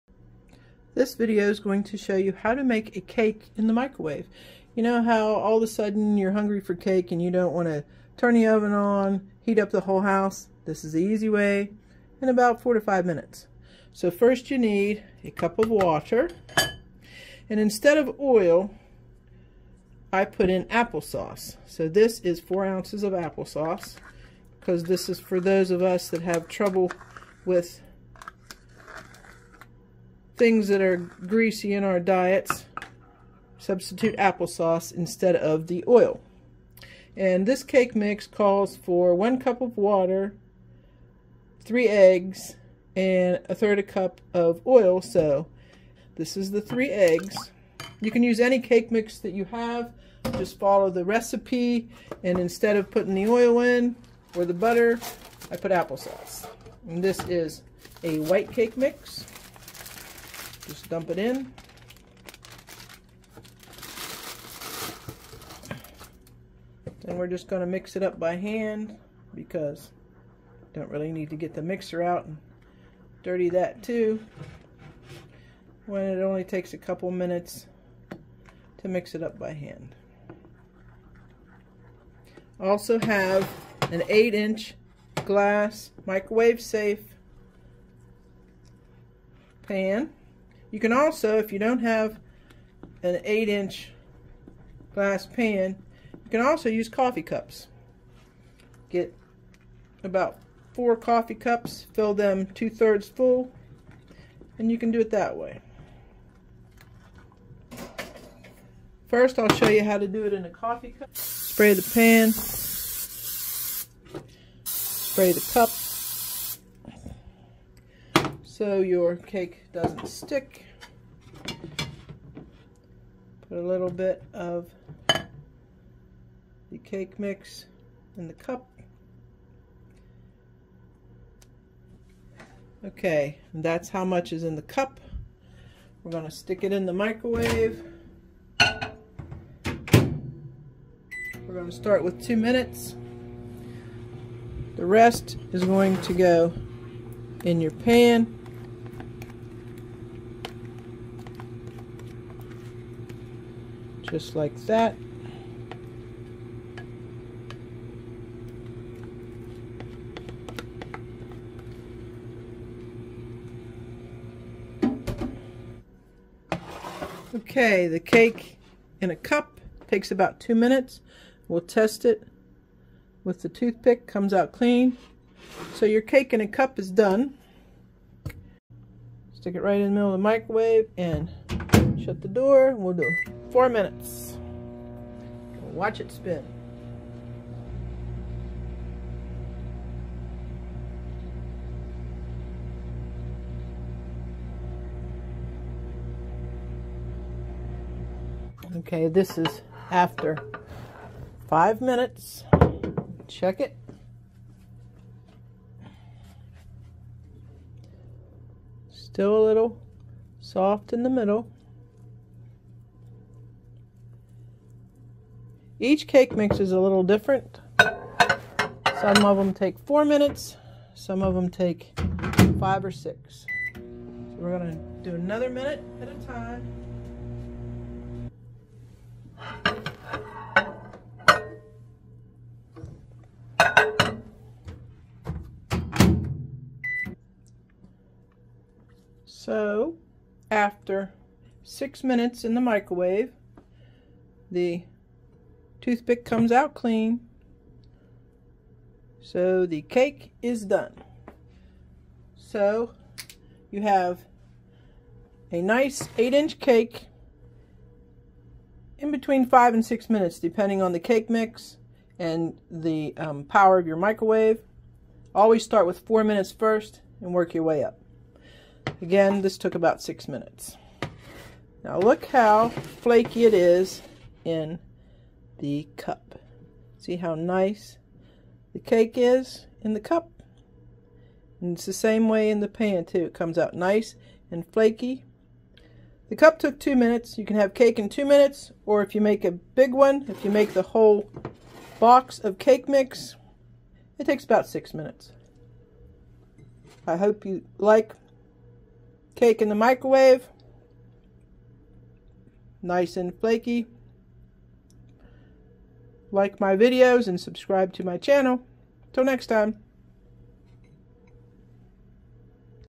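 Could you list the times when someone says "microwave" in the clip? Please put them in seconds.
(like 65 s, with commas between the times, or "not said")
3 s, 86 s, 136 s, 180 s, 242 s, 263 s, 299 s.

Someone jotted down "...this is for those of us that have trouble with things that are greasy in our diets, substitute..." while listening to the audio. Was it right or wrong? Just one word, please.
right.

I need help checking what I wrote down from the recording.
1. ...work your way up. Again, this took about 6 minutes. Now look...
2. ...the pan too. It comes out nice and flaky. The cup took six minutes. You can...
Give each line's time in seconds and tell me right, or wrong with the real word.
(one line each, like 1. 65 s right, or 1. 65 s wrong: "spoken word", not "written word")
1. 267 s right
2. 282 s wrong: "two", not "six".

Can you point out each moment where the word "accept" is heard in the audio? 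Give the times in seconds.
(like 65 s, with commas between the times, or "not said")
not said.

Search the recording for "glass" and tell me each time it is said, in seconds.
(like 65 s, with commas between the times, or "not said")
85 s, 94 s.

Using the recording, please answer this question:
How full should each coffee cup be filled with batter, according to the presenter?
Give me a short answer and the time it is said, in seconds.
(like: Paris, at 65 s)
two-thirds, at 102 s.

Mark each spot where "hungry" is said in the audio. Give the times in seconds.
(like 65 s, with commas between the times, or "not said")
6 s.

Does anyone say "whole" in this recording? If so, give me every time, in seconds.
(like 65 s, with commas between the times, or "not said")
9 s, 290 s.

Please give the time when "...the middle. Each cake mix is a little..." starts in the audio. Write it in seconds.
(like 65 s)
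211 s.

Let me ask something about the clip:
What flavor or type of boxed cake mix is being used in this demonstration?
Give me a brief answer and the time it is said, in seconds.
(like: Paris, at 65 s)
white, at 57 s.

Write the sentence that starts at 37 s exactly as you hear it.
And this cake mix calls for one cup of water, three eggs, and a third a cup of oil.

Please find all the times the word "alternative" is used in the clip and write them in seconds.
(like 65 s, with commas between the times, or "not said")
not said.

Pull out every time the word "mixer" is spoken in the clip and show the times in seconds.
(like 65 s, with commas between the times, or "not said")
71 s.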